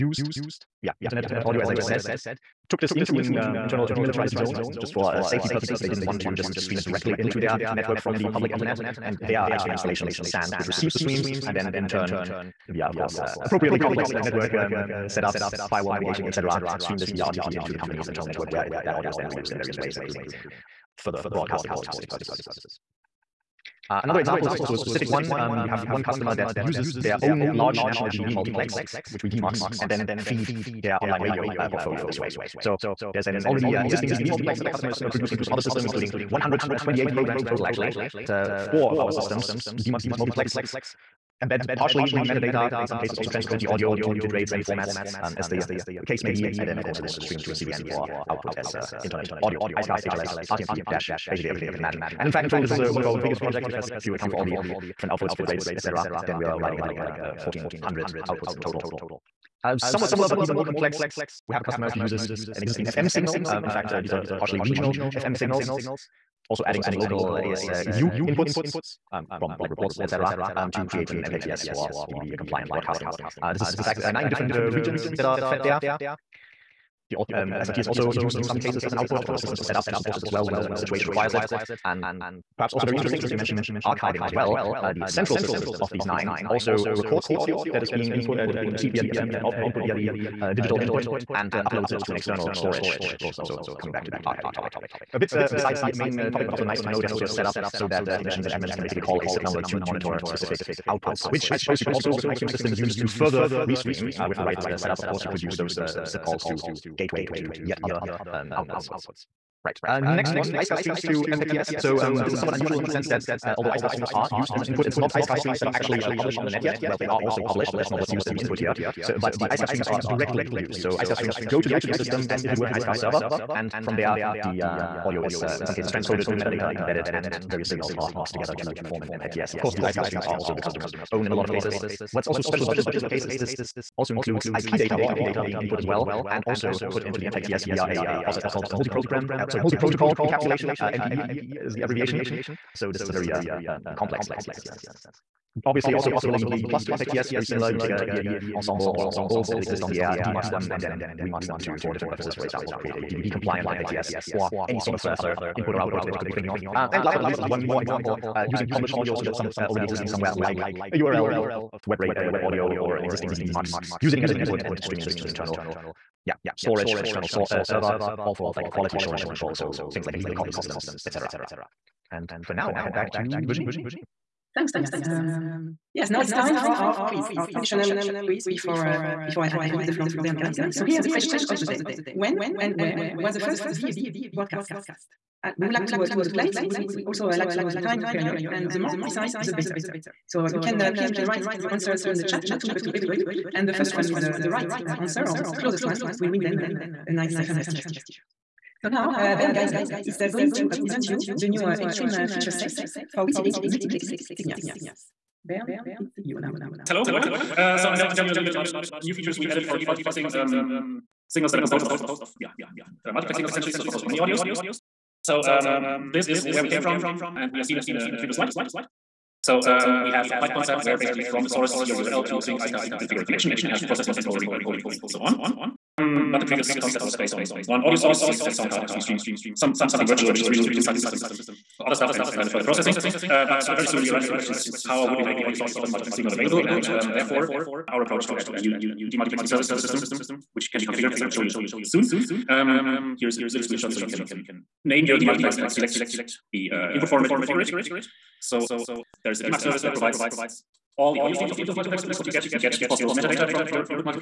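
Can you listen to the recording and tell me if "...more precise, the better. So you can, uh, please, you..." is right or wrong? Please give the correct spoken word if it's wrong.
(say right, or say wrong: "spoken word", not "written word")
right.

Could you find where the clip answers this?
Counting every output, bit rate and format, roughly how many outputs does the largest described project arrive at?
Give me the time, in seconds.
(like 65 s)
57 s.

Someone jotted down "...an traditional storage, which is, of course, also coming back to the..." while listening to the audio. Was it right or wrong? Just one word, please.
wrong.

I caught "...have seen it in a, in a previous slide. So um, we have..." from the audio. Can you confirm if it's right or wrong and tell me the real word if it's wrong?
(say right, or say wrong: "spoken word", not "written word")
right.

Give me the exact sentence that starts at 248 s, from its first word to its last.
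So there is a DMAC service that provides all the audio streams of the input multiplex.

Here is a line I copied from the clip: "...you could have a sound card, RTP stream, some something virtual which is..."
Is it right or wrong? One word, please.
right.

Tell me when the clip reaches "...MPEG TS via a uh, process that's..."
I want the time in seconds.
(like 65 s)
137 s.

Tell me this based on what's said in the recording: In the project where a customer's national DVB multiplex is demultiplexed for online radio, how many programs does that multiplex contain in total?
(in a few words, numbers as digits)
128.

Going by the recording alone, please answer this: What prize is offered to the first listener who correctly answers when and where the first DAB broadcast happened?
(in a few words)
Ferncast t-shirt.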